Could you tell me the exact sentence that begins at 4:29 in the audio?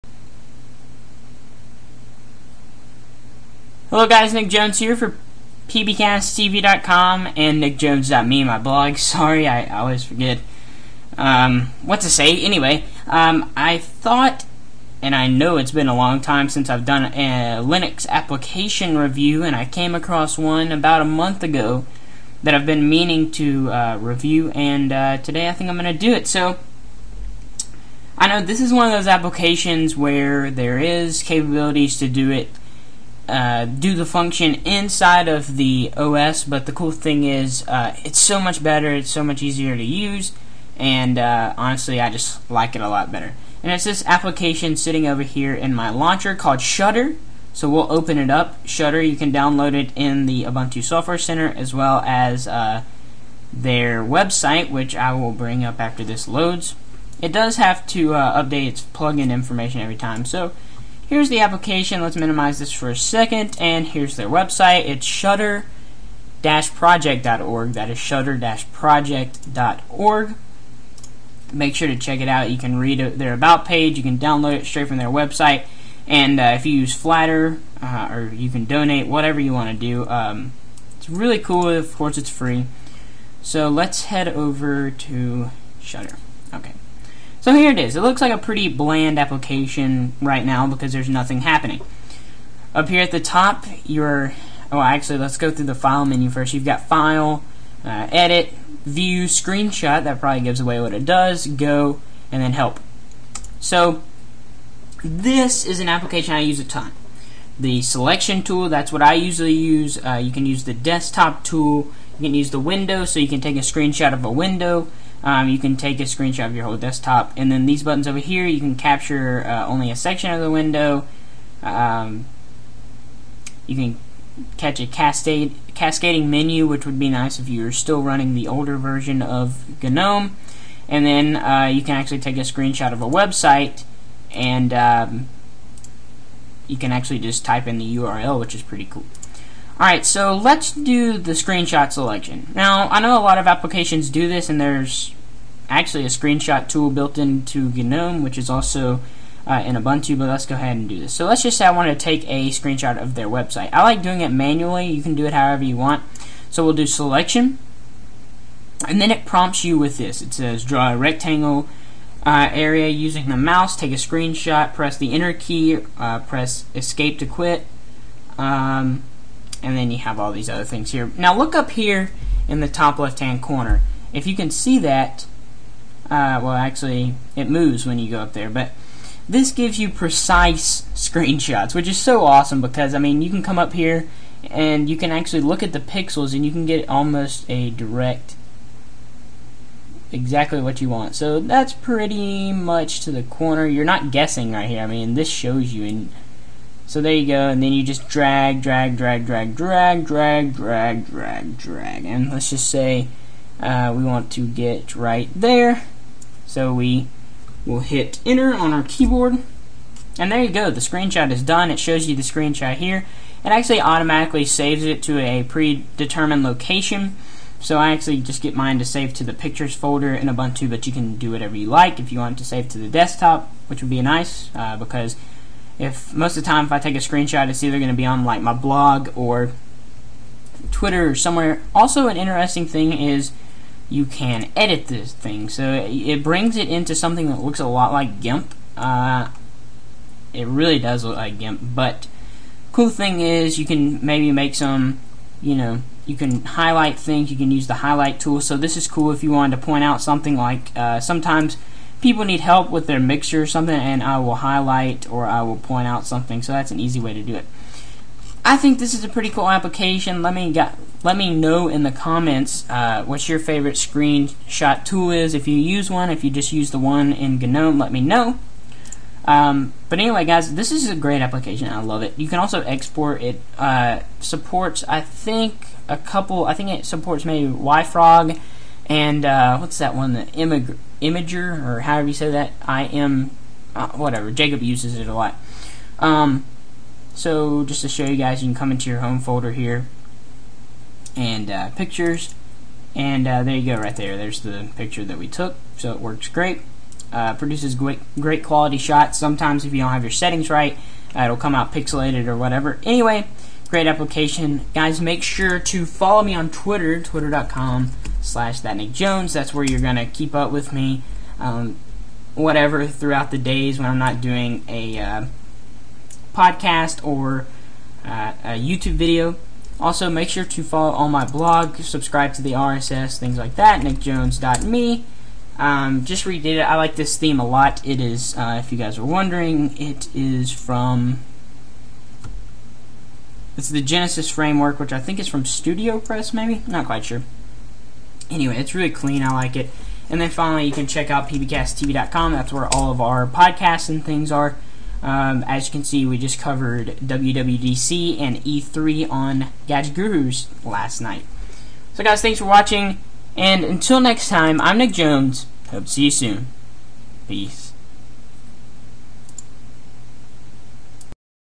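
Um, but anyway, guys, this is a great application.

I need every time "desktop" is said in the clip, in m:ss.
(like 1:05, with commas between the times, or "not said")
1:50, 1:56, 3:42.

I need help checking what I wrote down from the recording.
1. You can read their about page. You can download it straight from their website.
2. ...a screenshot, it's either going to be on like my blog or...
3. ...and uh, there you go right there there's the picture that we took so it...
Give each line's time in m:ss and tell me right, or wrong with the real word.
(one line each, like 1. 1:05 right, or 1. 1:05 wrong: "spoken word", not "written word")
1. 1:12 right
2. 3:46 right
3. 4:52 right.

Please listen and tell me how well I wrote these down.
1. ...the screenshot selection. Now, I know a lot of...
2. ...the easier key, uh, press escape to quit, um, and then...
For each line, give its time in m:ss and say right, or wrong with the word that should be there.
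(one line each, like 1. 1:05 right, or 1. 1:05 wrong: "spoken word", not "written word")
1. 2:21 right
2. 2:44 wrong: "enter", not "easier".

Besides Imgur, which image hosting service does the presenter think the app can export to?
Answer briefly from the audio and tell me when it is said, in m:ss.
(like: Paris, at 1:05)
YFrog, at 4:37.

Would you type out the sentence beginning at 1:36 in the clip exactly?
You've got file, uh, edit, view, screenshot.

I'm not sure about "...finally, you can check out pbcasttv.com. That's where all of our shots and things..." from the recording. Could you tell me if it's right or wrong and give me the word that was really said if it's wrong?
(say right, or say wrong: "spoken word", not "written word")
wrong: "podcasts", not "shots".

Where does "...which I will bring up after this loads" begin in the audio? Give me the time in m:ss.
0:54.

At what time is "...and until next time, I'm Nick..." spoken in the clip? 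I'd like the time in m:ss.
5:53.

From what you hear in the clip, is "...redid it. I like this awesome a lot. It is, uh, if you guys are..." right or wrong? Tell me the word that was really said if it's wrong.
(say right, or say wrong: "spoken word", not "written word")
wrong: "theme", not "awesome".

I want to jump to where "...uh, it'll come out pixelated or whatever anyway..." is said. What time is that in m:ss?
5:01.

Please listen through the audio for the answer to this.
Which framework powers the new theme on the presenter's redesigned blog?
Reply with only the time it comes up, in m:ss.
5:33.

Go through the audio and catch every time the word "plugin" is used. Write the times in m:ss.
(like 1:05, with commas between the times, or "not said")
0:58.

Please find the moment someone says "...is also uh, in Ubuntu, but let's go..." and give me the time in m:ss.
2:28.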